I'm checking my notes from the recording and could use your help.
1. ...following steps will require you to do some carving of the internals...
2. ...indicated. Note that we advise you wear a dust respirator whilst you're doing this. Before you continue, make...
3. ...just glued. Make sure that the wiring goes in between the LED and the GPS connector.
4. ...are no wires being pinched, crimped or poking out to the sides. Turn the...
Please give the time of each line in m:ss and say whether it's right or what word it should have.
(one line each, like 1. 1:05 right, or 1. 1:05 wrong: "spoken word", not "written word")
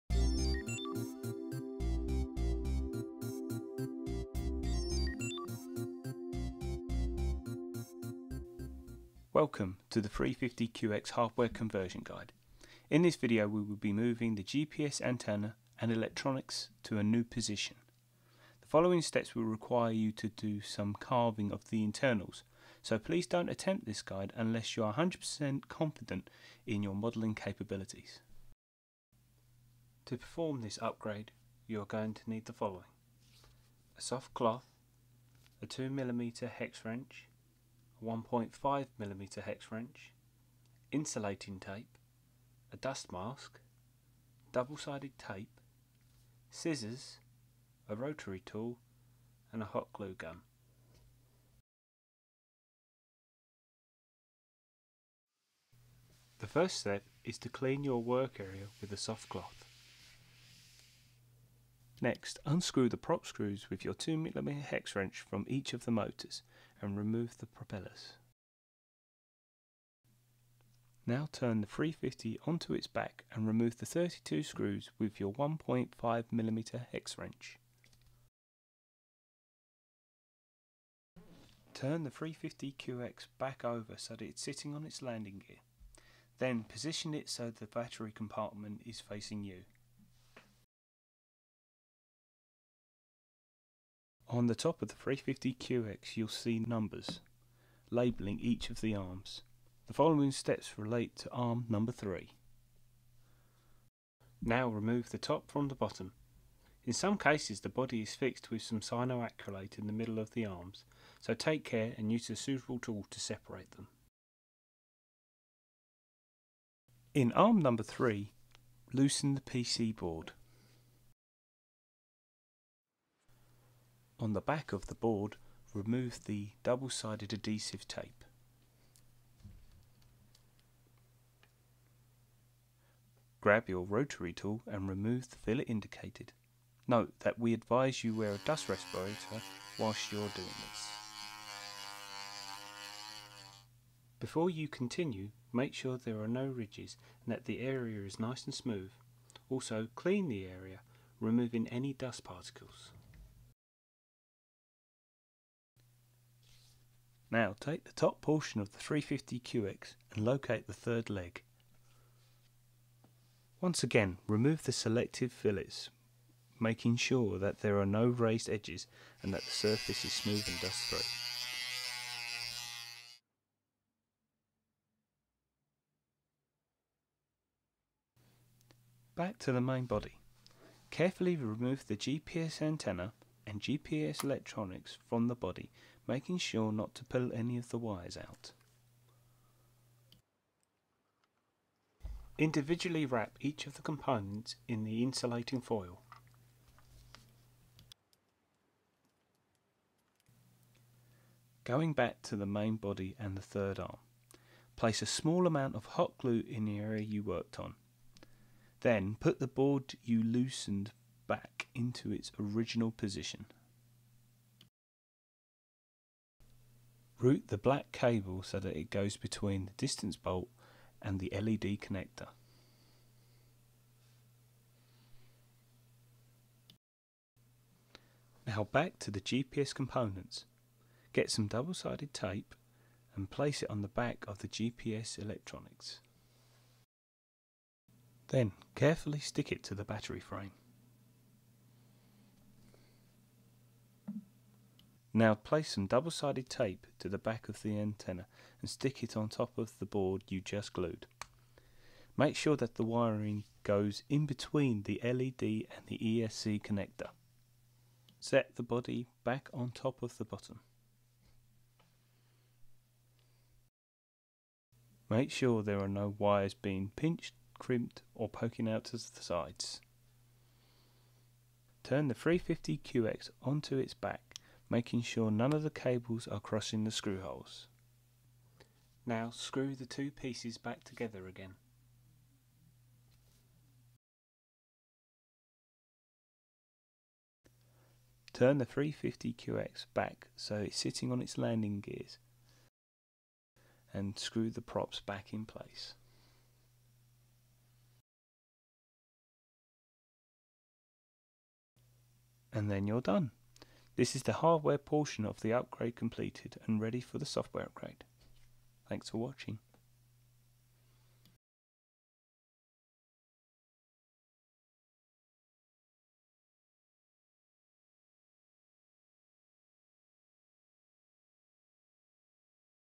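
1. 0:18 right
2. 2:15 right
3. 4:10 wrong: "ESC", not "GPS"
4. 4:25 right.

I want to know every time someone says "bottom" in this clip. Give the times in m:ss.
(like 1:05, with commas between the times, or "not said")
1:45, 4:20.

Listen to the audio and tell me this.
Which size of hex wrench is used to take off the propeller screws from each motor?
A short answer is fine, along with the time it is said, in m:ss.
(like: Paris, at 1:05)
2mm, at 0:35.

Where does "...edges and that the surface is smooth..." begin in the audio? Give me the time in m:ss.
2:48.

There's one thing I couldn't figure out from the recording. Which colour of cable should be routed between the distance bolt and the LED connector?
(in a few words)
black.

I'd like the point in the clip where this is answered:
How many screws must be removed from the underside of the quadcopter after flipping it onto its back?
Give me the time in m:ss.
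1:13.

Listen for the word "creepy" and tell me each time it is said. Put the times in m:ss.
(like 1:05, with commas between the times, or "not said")
not said.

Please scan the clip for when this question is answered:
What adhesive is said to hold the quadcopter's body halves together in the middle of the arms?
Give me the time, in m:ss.
1:48.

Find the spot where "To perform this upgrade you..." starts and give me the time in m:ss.
0:30.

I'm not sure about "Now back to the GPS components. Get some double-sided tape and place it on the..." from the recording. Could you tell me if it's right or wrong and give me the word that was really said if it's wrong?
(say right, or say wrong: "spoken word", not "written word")
right.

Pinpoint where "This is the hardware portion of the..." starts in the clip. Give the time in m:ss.
5:03.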